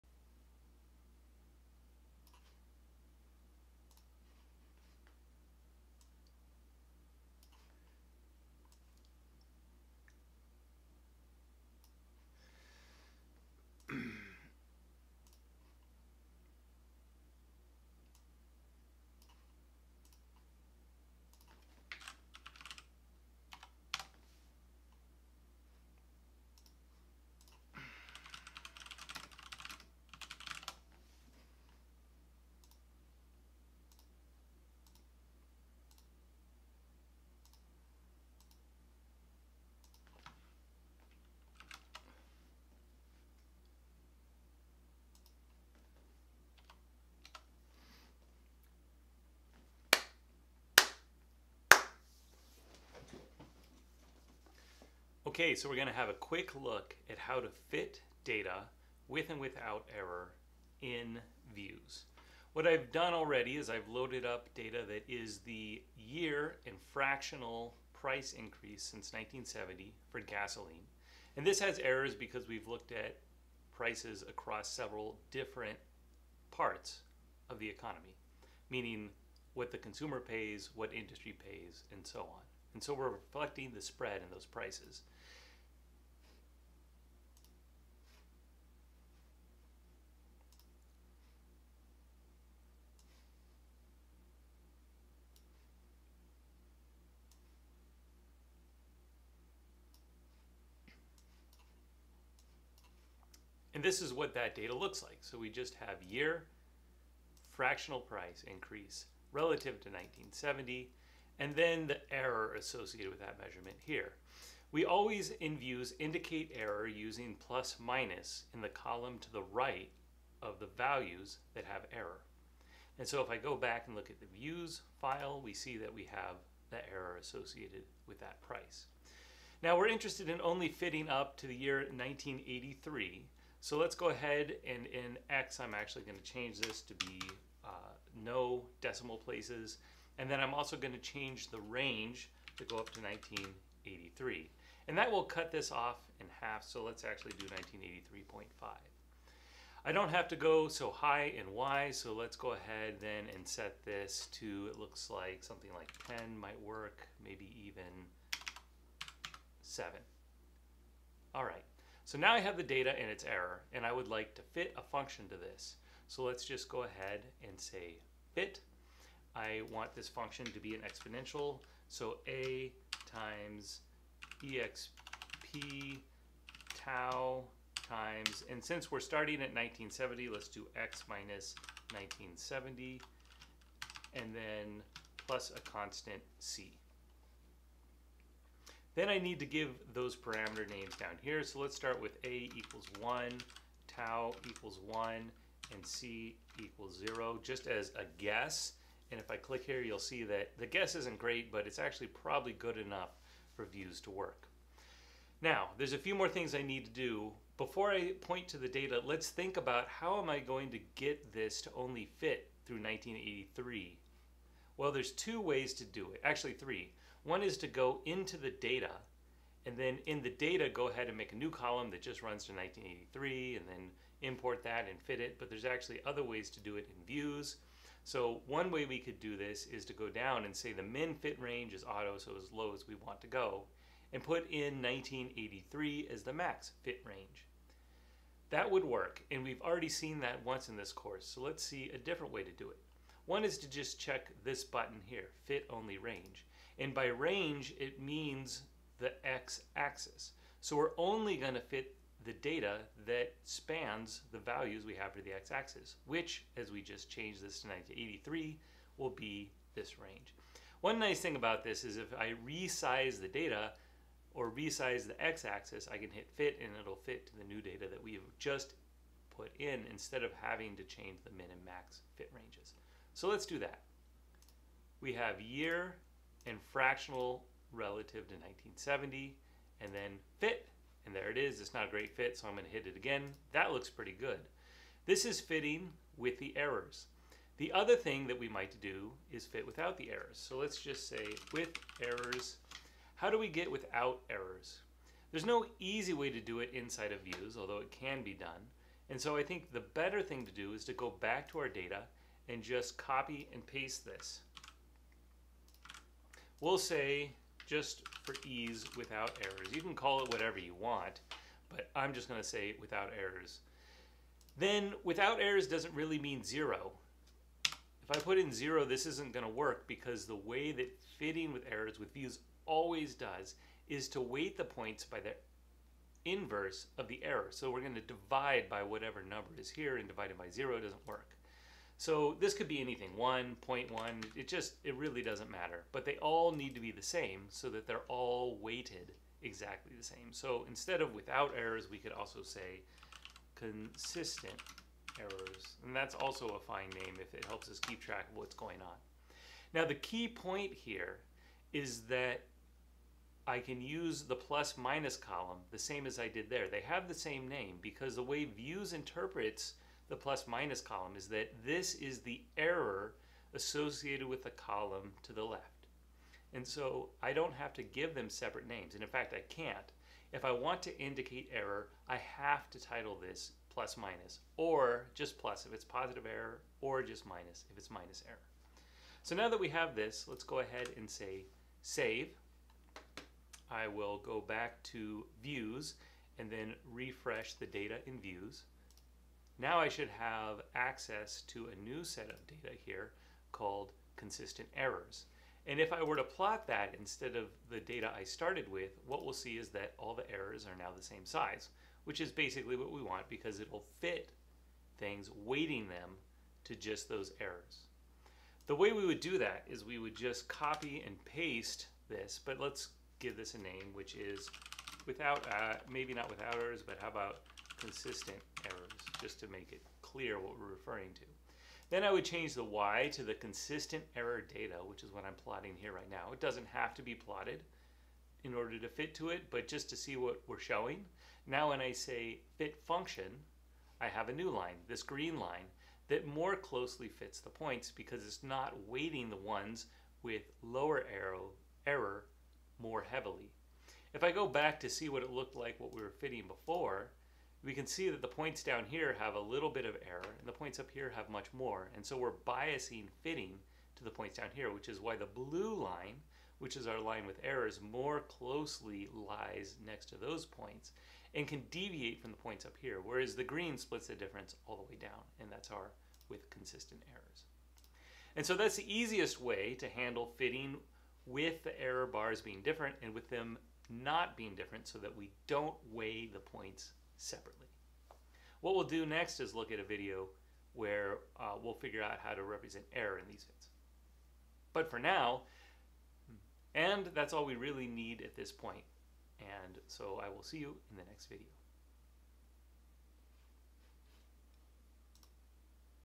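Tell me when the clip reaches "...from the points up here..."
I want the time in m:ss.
7:42.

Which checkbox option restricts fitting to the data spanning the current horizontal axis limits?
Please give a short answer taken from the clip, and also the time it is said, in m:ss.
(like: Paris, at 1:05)
Fit only range, at 4:05.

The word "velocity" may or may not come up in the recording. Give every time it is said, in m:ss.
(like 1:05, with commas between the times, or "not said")
not said.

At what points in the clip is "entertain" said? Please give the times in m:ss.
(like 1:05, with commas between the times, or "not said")
not said.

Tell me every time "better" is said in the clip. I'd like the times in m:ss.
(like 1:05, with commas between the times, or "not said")
4:59.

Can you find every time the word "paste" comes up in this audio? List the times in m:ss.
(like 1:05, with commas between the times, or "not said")
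5:03, 6:51.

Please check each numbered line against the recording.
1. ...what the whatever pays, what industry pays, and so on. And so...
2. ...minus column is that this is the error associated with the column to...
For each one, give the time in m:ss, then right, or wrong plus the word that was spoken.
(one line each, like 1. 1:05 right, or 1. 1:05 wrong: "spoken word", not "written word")
1. 1:19 wrong: "consumer", not "whatever"
2. 6:00 right.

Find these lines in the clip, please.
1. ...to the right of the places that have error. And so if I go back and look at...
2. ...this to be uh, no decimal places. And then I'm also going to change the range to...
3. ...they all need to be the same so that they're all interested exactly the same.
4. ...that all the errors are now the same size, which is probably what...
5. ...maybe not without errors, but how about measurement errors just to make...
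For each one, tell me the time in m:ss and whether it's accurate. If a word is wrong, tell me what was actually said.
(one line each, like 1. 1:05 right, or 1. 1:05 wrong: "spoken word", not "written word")
1. 1:59 wrong: "values", not "places"
2. 2:16 right
3. 5:36 wrong: "weighted", not "interested"
4. 6:39 wrong: "basically", not "probably"
5. 6:55 wrong: "consistent", not "measurement".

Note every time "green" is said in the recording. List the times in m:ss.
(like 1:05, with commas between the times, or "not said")
7:15, 7:43.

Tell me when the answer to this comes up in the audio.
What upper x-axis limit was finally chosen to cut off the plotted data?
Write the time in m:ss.
2:27.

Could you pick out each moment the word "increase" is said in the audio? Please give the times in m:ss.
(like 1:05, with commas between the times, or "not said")
1:08, 1:48.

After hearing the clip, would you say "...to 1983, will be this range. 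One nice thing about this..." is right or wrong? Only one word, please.
right.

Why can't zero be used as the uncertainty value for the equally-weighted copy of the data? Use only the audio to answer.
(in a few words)
Dividing by zero.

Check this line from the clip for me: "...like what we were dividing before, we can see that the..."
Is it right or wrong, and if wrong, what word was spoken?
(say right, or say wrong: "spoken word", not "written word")
wrong: "fitting", not "dividing".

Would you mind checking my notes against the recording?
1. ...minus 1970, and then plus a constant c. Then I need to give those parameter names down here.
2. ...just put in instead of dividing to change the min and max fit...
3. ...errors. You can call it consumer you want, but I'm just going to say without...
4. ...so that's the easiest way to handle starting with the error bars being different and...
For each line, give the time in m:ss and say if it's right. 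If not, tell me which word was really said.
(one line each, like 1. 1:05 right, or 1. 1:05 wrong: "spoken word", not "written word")
1. 3:01 right
2. 4:28 wrong: "having", not "dividing"
3. 5:09 wrong: "whatever", not "consumer"
4. 7:48 wrong: "fitting", not "starting".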